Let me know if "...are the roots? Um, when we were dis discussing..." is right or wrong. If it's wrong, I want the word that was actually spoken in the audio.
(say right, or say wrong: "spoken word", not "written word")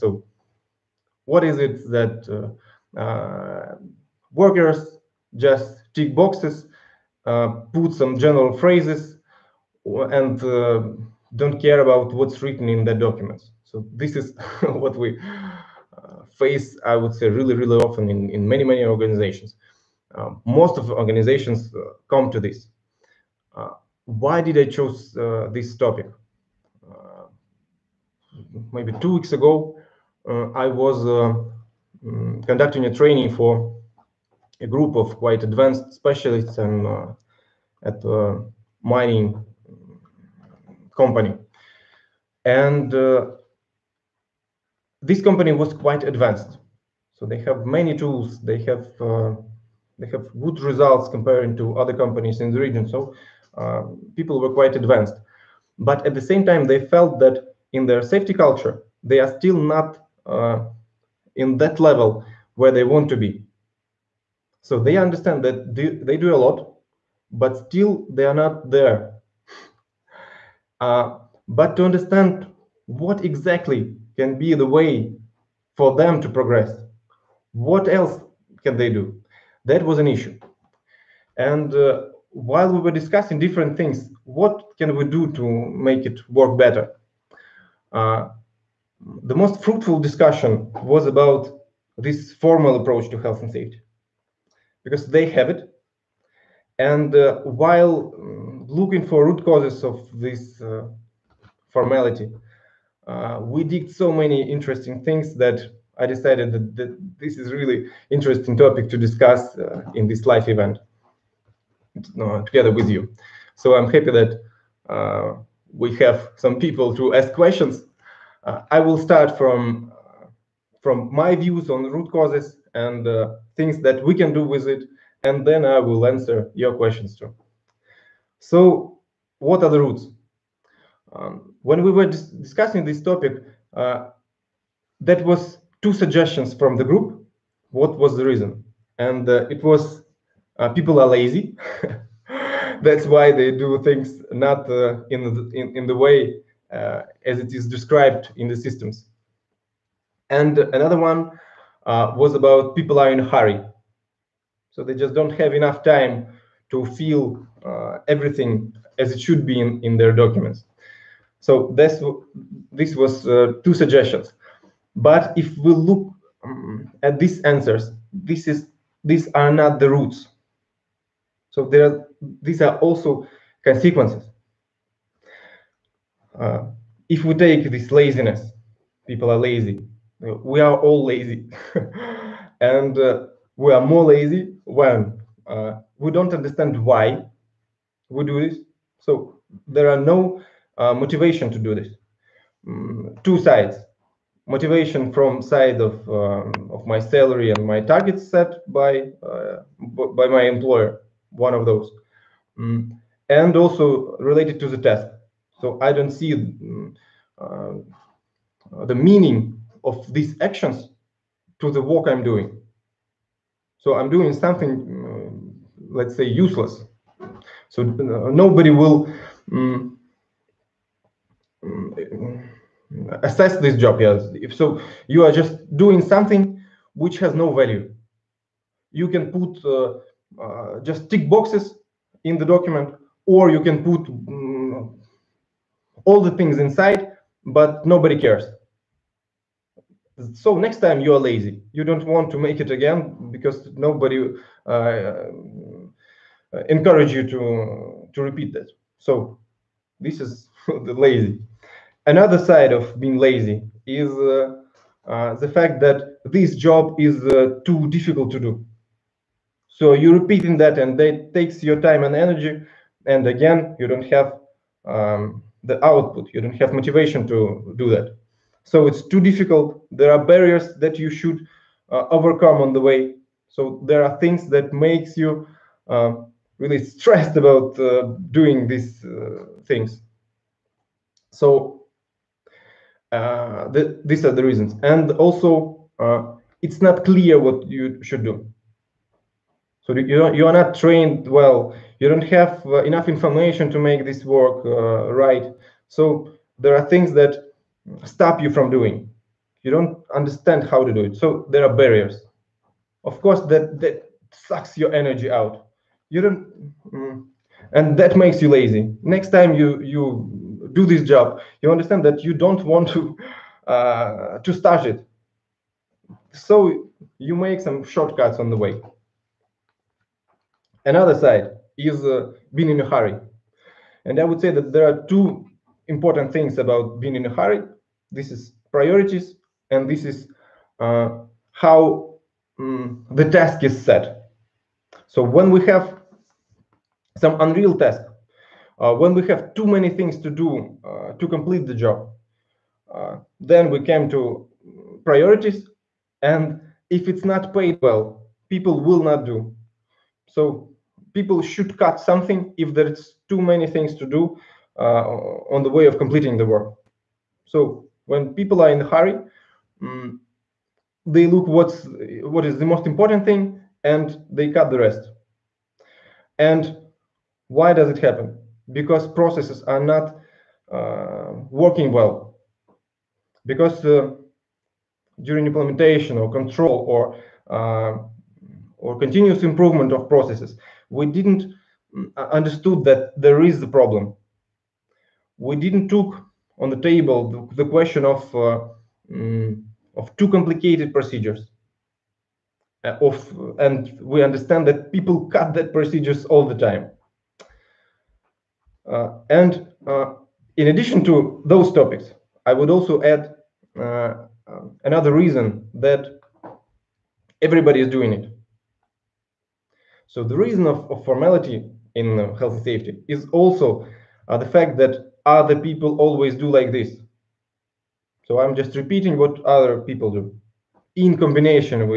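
right.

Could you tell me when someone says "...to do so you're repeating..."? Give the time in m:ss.
4:18.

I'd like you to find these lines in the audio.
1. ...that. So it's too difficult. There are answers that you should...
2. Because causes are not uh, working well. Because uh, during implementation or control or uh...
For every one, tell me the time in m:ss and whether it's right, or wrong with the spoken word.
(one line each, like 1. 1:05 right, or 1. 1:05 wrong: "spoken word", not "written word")
1. 4:27 wrong: "barriers", not "answers"
2. 6:08 wrong: "processes", not "causes".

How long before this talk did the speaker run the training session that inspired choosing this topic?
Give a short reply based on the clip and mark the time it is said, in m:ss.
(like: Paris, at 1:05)
2 weeks ago, at 0:29.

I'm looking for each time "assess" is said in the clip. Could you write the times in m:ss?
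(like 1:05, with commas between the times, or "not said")
3:43.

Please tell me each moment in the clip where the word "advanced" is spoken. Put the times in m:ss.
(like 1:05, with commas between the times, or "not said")
0:35, 0:46, 0:54.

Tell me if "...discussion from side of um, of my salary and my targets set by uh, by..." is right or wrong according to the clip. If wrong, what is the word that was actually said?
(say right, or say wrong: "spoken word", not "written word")
wrong: "motivation", not "discussion".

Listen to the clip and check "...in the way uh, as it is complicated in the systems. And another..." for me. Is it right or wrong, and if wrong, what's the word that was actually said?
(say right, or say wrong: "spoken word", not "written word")
wrong: "described", not "complicated".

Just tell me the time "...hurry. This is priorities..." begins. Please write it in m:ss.
5:27.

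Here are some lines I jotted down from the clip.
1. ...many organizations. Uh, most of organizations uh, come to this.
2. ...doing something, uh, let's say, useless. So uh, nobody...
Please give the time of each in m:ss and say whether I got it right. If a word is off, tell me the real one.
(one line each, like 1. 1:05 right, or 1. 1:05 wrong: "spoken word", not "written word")
1. 0:18 right
2. 3:34 right.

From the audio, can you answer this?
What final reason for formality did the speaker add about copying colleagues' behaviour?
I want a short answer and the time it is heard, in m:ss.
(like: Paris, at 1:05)
Everybody is doing it, at 6:47.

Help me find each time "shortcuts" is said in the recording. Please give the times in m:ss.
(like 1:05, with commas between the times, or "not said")
5:17.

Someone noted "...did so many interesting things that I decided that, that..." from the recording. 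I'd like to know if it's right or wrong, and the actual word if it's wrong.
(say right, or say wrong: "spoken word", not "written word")
right.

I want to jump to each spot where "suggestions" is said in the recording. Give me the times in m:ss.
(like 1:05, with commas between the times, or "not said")
2:15, 2:43.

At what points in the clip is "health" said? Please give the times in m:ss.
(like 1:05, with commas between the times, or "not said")
1:33, 6:52.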